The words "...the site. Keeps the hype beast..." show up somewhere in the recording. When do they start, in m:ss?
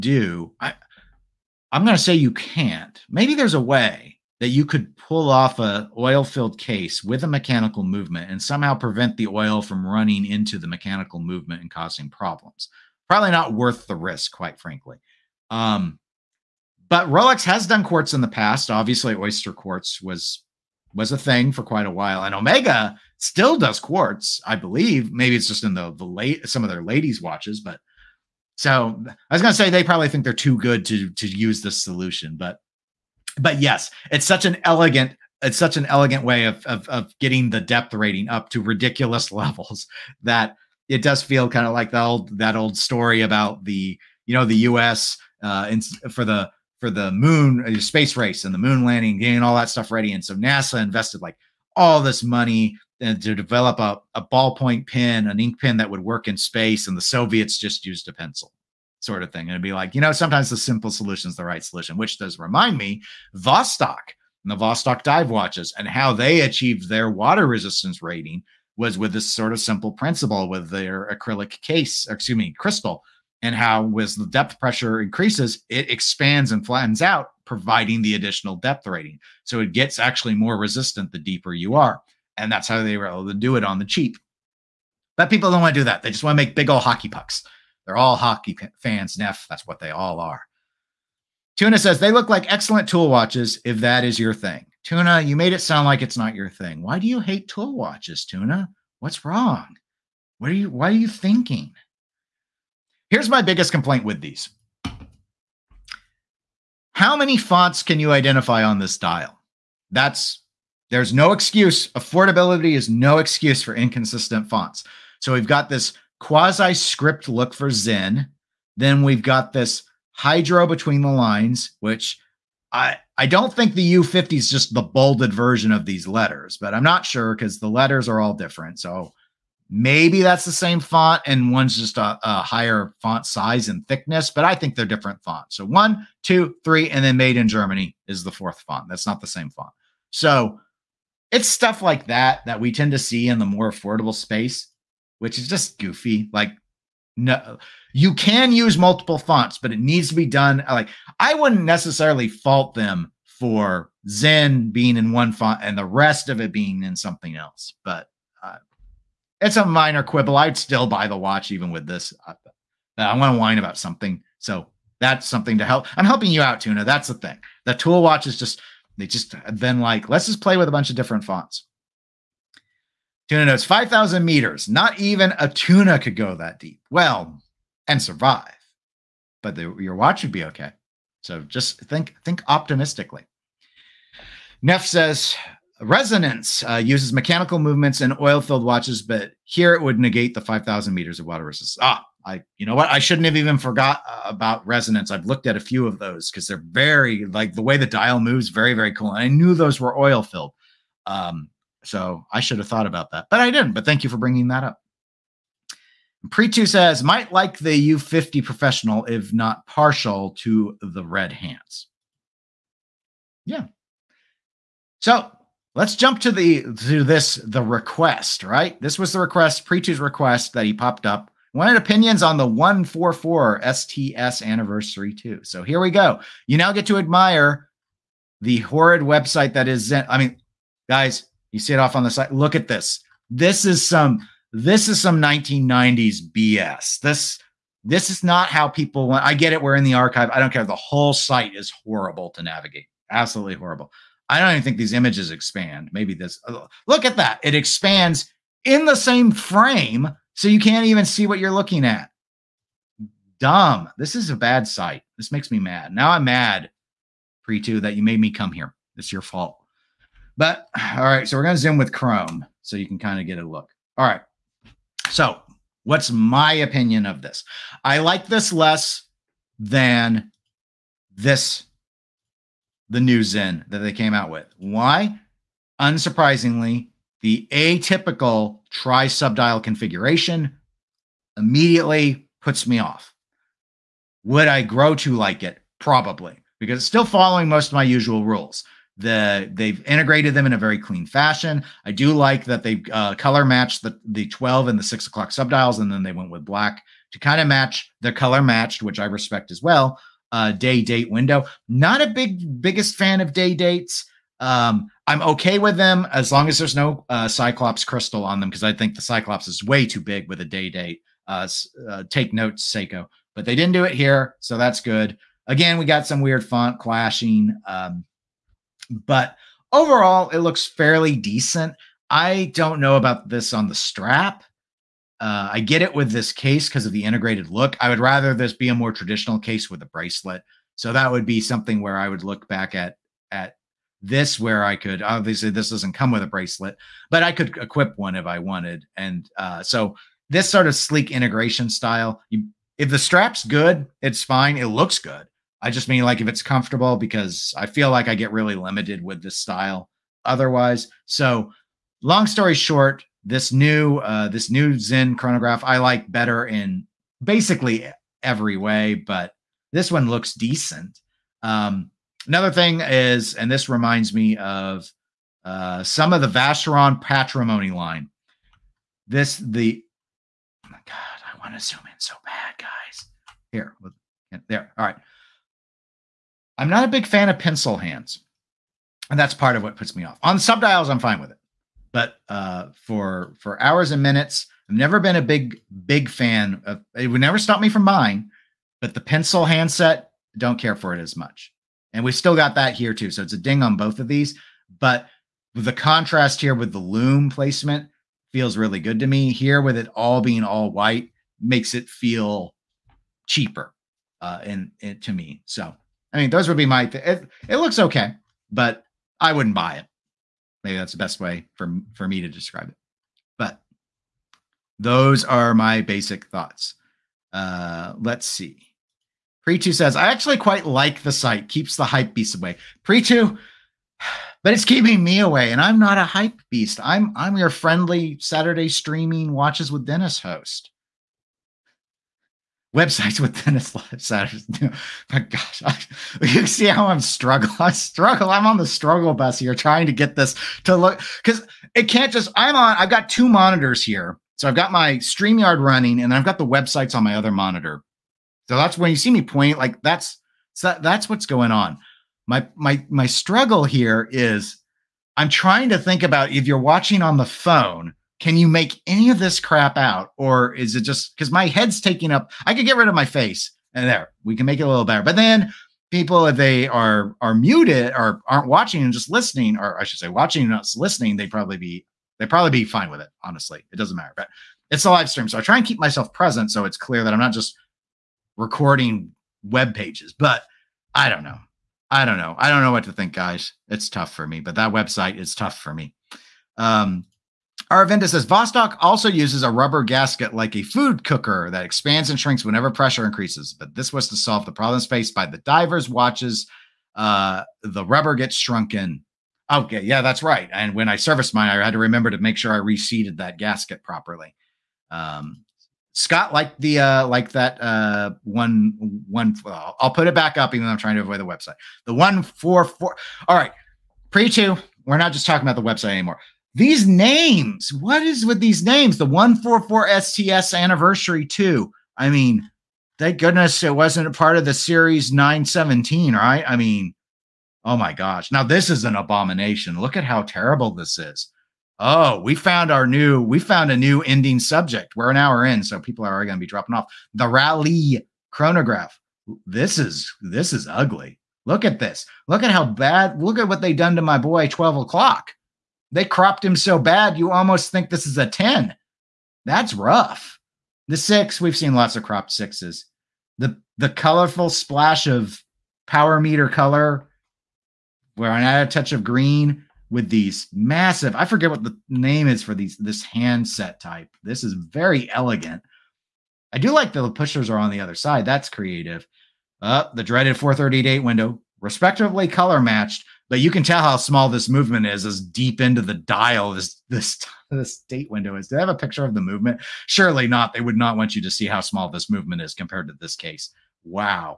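7:01.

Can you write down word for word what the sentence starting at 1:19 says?
So it gets actually more resistant the deeper you are.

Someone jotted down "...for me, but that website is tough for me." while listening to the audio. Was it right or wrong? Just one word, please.
right.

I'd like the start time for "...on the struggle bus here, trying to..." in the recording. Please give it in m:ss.
7:18.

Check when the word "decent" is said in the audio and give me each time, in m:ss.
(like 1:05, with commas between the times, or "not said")
5:21, 6:00.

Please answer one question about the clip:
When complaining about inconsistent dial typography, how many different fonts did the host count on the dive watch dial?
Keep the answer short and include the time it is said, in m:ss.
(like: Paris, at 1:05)
4, at 2:18.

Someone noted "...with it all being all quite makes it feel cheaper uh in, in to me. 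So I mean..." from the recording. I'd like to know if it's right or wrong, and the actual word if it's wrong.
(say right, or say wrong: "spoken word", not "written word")
wrong: "white", not "quite".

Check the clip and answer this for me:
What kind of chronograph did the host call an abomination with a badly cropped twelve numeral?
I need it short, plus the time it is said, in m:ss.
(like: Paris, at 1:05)
Rally chronograph, at 8:57.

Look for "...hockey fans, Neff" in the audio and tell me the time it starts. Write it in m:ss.
1:28.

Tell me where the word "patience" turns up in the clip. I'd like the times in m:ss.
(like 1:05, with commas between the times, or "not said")
not said.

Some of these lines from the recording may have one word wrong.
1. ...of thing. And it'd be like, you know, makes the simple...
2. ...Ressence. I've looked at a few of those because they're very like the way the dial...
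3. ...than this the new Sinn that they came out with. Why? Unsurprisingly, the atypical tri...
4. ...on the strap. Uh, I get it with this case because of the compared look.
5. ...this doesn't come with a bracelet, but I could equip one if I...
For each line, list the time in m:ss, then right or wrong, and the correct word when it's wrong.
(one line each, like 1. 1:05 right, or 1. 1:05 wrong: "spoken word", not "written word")
1. 0:59 wrong: "sometimes", not "makes"
2. 3:14 right
3. 4:29 right
4. 5:23 wrong: "integrated", not "compared"
5. 5:35 right.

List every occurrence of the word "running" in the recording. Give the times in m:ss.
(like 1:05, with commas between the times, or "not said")
0:09, 7:25.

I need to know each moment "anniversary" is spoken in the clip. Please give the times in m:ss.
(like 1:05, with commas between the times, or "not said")
3:44, 8:40.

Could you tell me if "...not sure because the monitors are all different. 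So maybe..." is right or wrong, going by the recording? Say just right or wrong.
wrong.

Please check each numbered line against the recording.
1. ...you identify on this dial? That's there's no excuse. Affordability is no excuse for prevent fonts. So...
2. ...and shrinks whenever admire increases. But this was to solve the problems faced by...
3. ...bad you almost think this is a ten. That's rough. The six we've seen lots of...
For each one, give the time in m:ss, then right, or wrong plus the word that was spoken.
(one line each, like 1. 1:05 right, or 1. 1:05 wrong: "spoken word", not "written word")
1. 1:47 wrong: "inconsistent", not "prevent"
2. 8:12 wrong: "pressure", not "admire"
3. 9:06 right.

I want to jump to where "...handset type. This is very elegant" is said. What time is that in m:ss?
9:23.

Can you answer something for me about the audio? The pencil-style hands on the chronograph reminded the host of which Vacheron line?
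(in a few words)
Patrimony.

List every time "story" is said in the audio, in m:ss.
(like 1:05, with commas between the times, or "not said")
0:42, 5:52.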